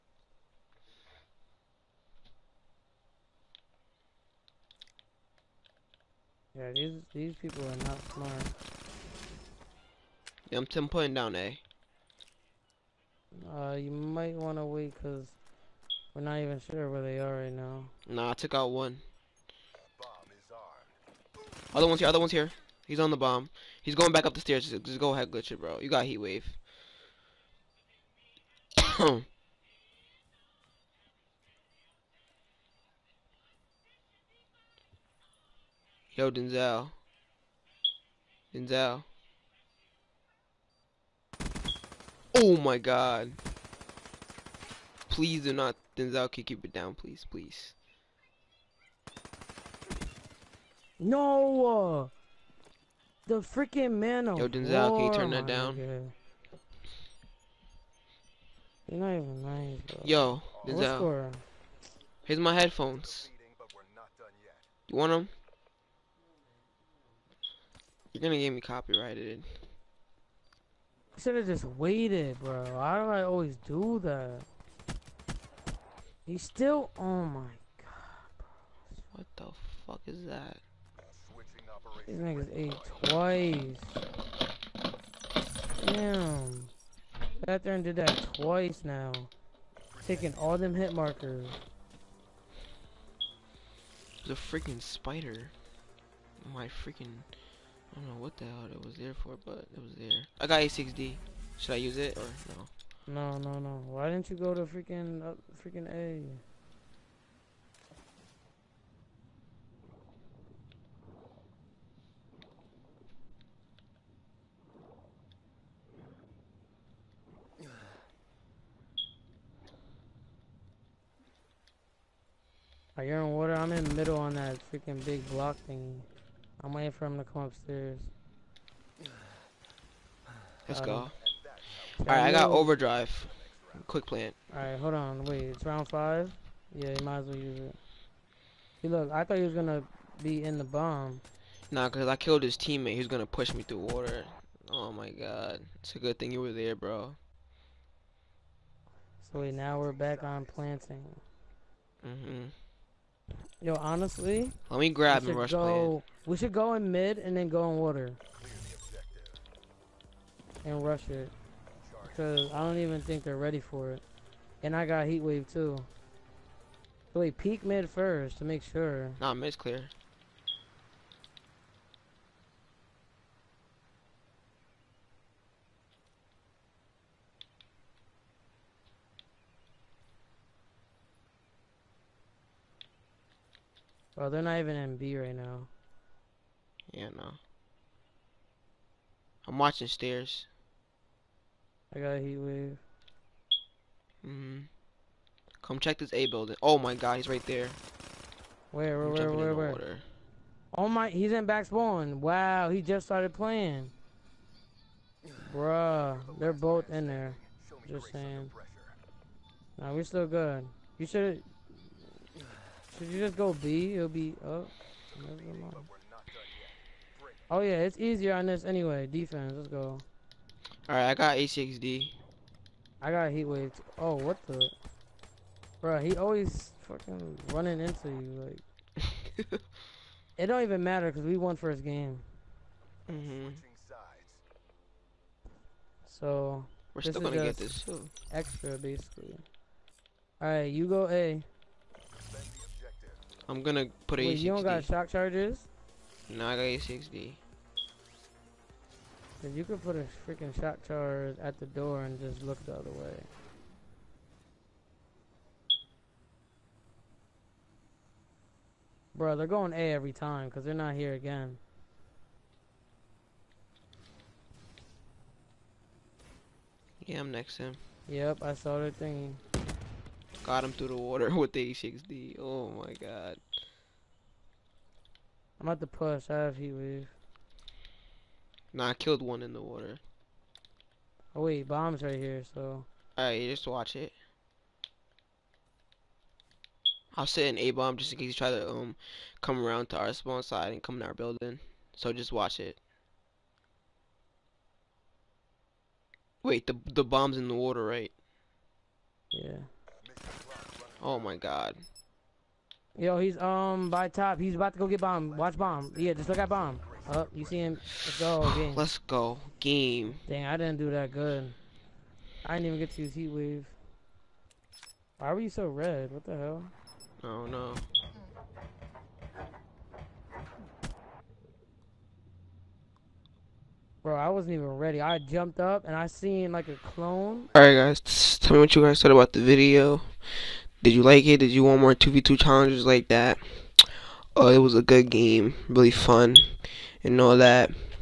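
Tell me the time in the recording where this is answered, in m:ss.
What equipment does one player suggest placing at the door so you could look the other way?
4:10.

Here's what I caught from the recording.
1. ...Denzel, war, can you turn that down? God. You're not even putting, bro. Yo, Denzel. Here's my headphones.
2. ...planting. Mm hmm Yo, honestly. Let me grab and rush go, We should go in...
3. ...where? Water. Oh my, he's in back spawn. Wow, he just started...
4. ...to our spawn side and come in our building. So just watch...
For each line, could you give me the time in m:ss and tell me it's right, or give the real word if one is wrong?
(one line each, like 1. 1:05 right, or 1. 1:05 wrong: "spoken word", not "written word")
1. 0:54 wrong: "lying", not "putting"
2. 2:30 right
3. 3:19 right
4. 4:49 right.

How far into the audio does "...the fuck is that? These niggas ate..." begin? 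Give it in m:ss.
1:19.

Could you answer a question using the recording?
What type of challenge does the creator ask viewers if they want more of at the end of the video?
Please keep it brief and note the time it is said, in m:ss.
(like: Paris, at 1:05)
2v2 challenges, at 5:31.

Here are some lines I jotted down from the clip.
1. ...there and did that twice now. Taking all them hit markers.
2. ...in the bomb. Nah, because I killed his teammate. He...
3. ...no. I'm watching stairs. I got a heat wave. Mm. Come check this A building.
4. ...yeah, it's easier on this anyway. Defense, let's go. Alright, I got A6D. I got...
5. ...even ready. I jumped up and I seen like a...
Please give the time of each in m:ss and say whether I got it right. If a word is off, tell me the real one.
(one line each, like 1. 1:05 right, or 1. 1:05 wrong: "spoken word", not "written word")
1. 1:27 right
2. 2:20 right
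3. 3:07 right
4. 3:37 right
5. 5:24 right.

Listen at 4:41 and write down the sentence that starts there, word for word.
Oh wait, bombs right here, so.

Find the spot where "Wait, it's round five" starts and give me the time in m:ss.
2:15.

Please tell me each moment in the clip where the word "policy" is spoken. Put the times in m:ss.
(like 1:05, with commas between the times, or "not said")
not said.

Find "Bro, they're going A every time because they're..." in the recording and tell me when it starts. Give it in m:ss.
4:19.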